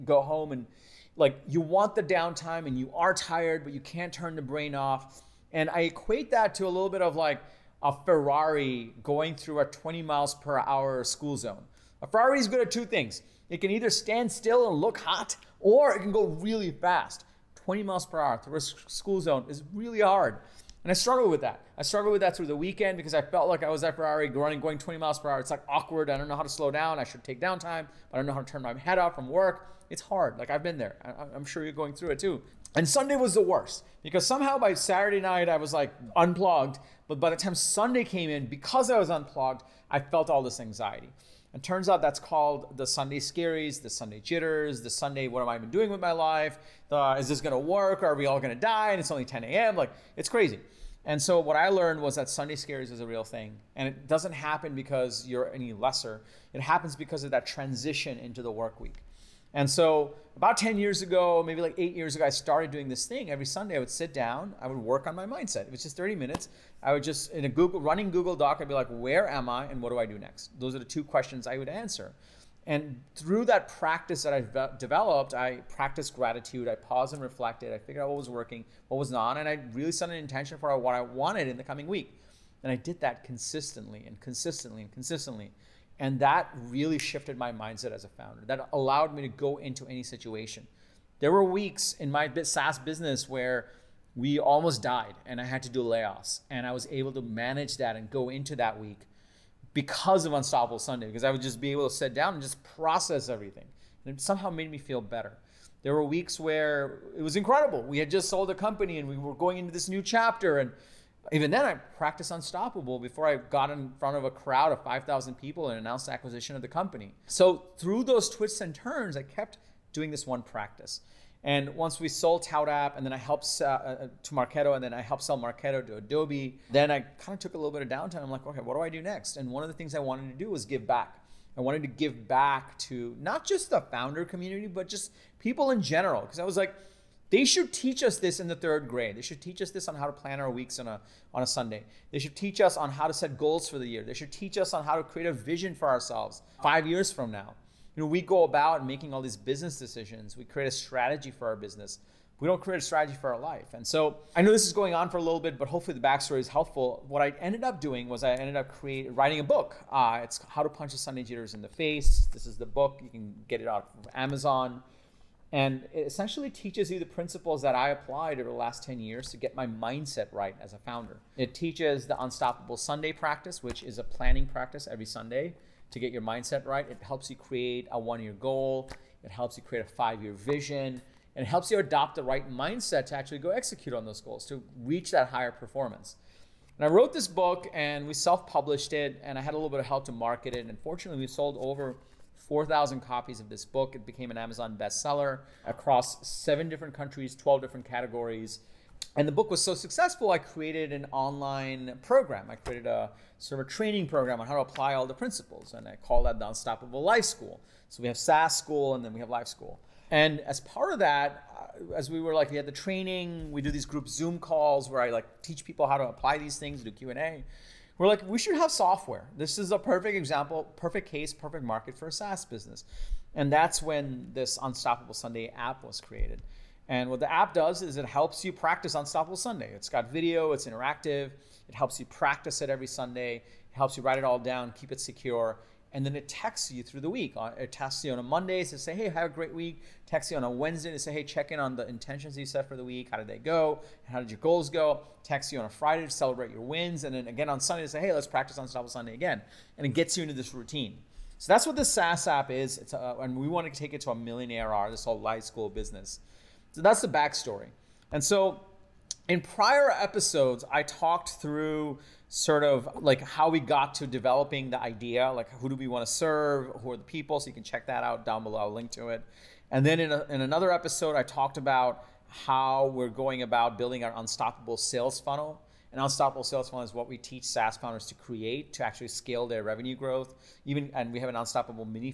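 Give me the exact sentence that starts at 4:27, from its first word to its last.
So you can check that out down below.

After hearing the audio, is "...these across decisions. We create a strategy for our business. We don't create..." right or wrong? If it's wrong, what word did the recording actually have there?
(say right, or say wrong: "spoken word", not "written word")
wrong: "business", not "across".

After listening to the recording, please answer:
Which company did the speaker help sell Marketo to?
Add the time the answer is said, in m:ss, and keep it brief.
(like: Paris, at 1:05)
Adobe, at 2:05.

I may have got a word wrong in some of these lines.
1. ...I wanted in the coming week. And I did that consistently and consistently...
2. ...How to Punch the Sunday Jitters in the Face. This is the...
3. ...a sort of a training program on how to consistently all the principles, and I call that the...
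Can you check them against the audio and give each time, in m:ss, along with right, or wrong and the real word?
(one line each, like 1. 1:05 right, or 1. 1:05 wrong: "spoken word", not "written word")
1. 1:20 right
2. 2:40 right
3. 3:22 wrong: "apply", not "consistently".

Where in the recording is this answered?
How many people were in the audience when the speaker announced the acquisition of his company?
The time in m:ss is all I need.
1:54.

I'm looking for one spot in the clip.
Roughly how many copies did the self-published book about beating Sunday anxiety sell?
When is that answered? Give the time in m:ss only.
3:11.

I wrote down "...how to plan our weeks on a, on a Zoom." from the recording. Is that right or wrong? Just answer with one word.
wrong.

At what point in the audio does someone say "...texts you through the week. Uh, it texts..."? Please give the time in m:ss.
3:56.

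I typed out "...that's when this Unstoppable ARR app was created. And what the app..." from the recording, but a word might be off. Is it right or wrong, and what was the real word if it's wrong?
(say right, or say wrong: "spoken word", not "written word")
wrong: "Sunday", not "ARR".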